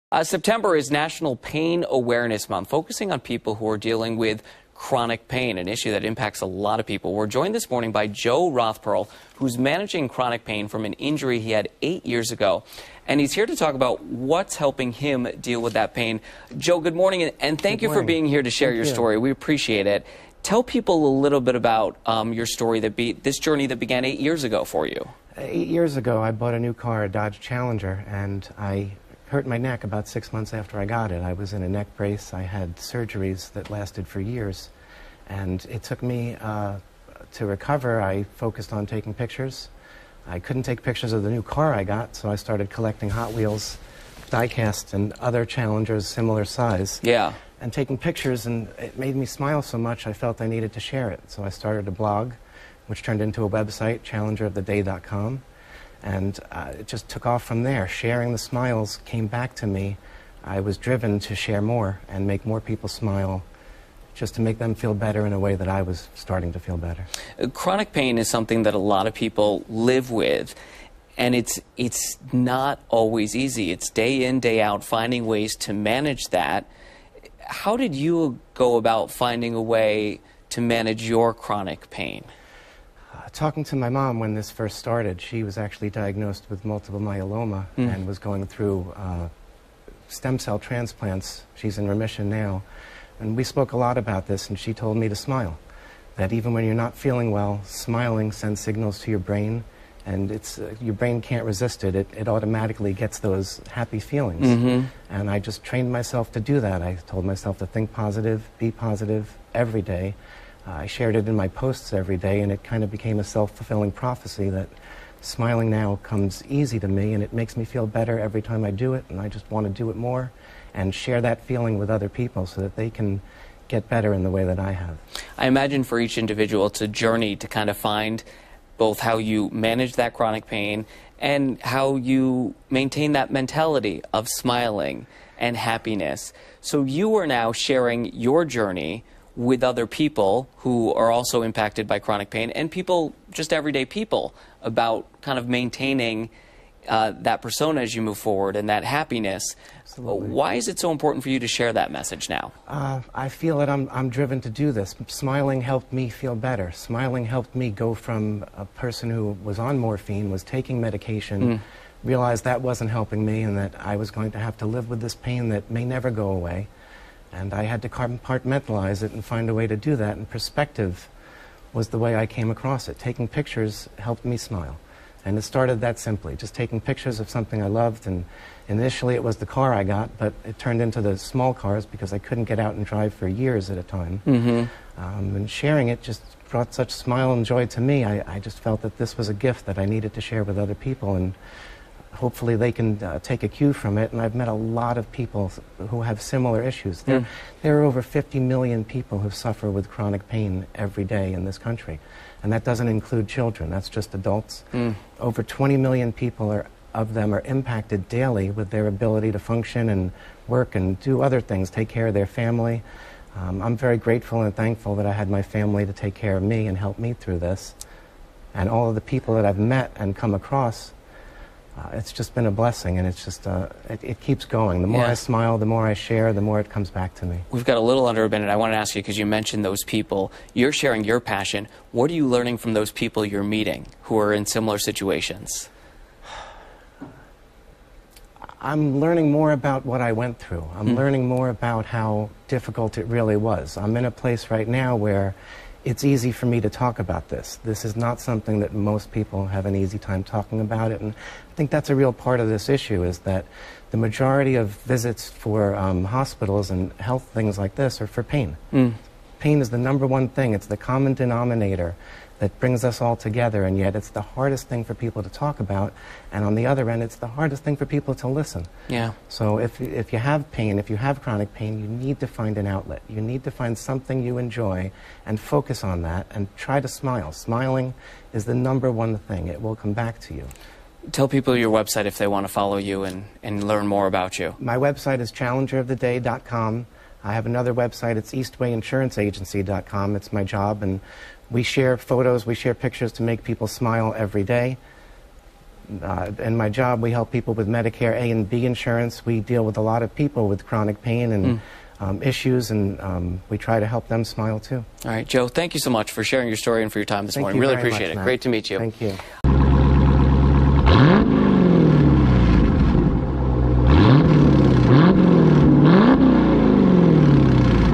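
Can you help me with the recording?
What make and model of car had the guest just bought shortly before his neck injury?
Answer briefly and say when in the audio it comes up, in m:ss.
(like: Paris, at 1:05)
Dodge Challenger, at 0:27.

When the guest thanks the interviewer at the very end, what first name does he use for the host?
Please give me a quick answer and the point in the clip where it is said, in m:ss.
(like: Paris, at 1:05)
Matt, at 5:08.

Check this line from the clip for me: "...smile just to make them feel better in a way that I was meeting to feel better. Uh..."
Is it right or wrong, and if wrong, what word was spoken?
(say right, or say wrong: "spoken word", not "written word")
wrong: "starting", not "meeting".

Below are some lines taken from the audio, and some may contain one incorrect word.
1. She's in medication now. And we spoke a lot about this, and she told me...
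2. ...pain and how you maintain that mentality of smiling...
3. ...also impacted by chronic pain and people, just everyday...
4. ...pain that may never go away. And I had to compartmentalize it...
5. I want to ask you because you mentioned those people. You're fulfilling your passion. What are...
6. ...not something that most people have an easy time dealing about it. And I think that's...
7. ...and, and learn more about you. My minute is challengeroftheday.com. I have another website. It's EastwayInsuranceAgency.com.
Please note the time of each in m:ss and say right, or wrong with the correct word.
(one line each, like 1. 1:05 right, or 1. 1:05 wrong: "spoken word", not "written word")
1. 1:31 wrong: "remission", not "medication"
2. 2:10 right
3. 2:21 right
4. 2:45 right
5. 3:48 wrong: "sharing", not "fulfilling"
6. 4:07 wrong: "talking", not "dealing"
7. 4:43 wrong: "website", not "minute".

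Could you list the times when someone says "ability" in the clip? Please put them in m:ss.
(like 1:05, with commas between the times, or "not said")
3:28.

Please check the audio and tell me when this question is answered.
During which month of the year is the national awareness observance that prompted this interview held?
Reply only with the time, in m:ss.
0:00.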